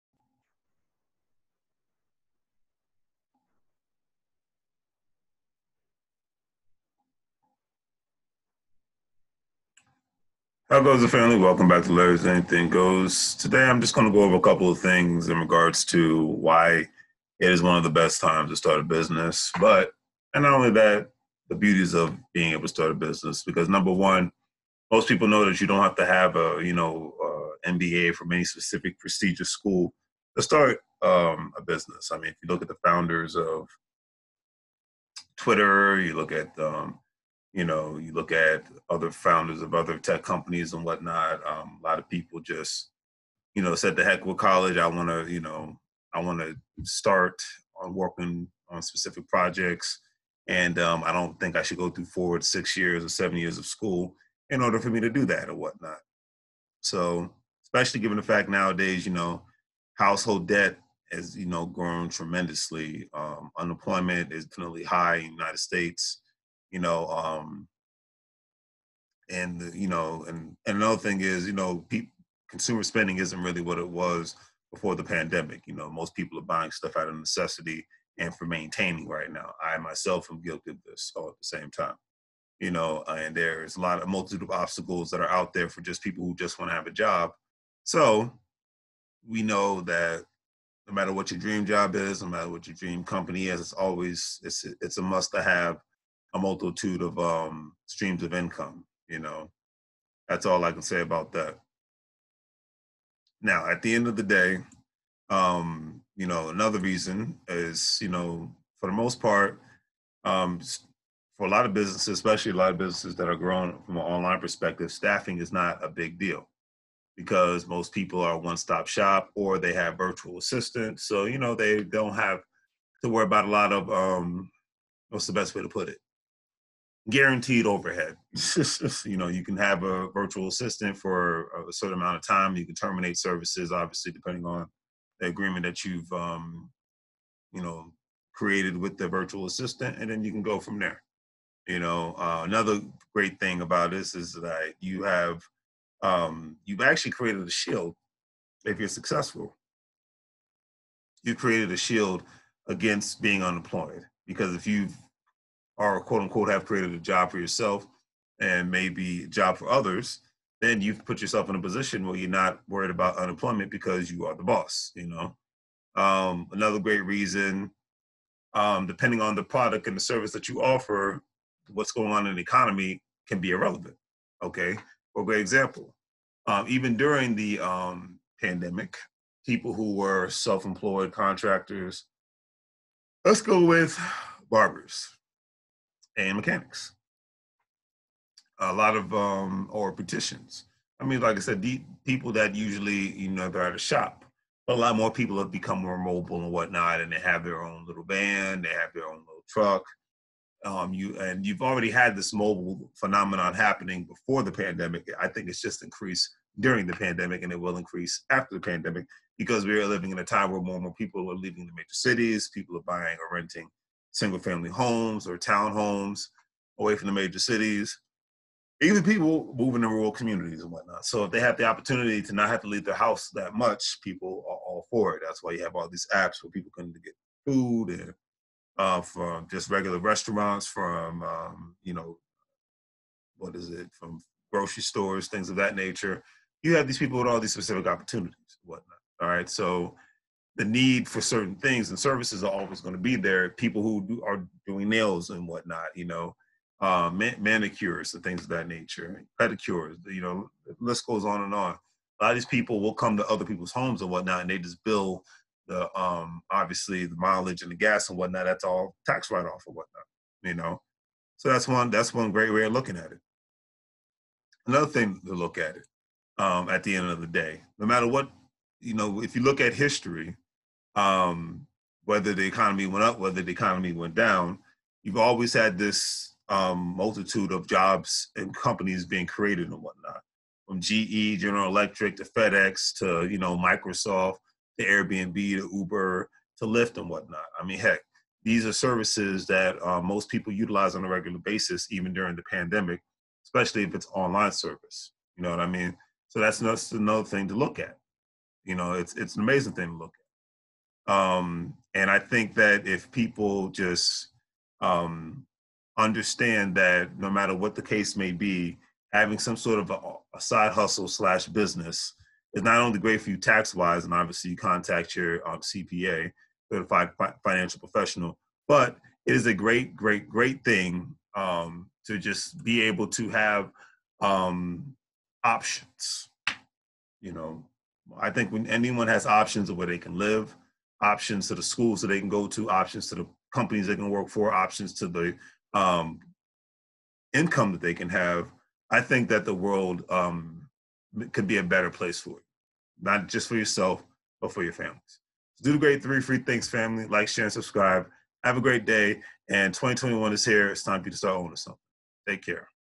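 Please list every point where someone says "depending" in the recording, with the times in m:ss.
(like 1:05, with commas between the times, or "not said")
2:14, 2:48.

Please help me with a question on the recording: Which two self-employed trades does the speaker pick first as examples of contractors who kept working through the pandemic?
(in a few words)
barbers and mechanics.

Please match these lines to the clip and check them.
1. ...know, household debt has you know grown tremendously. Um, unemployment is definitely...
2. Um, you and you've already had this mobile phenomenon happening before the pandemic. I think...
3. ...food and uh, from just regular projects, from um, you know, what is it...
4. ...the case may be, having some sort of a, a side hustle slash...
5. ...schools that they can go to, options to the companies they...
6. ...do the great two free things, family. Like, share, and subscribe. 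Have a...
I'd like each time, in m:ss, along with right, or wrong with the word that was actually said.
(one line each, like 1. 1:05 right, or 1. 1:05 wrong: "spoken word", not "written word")
1. 0:59 right
2. 3:20 right
3. 3:47 wrong: "restaurants", not "projects"
4. 5:07 right
5. 5:31 right
6. 5:45 wrong: "three", not "two".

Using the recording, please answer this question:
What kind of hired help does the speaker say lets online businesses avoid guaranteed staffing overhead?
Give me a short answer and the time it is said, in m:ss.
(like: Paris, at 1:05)
virtual assistants, at 1:59.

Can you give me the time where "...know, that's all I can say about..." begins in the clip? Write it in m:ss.
1:39.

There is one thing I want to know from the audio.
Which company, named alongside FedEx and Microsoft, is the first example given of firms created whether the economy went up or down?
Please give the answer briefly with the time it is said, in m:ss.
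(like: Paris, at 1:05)
General Electric, at 4:41.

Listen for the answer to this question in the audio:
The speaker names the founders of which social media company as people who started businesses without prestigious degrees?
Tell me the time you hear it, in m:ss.
0:35.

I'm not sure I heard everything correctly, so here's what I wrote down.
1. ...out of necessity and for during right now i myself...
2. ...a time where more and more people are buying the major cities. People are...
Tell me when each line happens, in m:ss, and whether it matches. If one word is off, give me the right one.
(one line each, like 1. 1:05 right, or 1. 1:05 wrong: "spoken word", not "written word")
1. 1:16 wrong: "maintaining", not "during"
2. 3:30 wrong: "leaving", not "buying".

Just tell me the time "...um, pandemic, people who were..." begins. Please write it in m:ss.
2:57.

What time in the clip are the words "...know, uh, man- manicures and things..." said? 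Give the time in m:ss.
4:06.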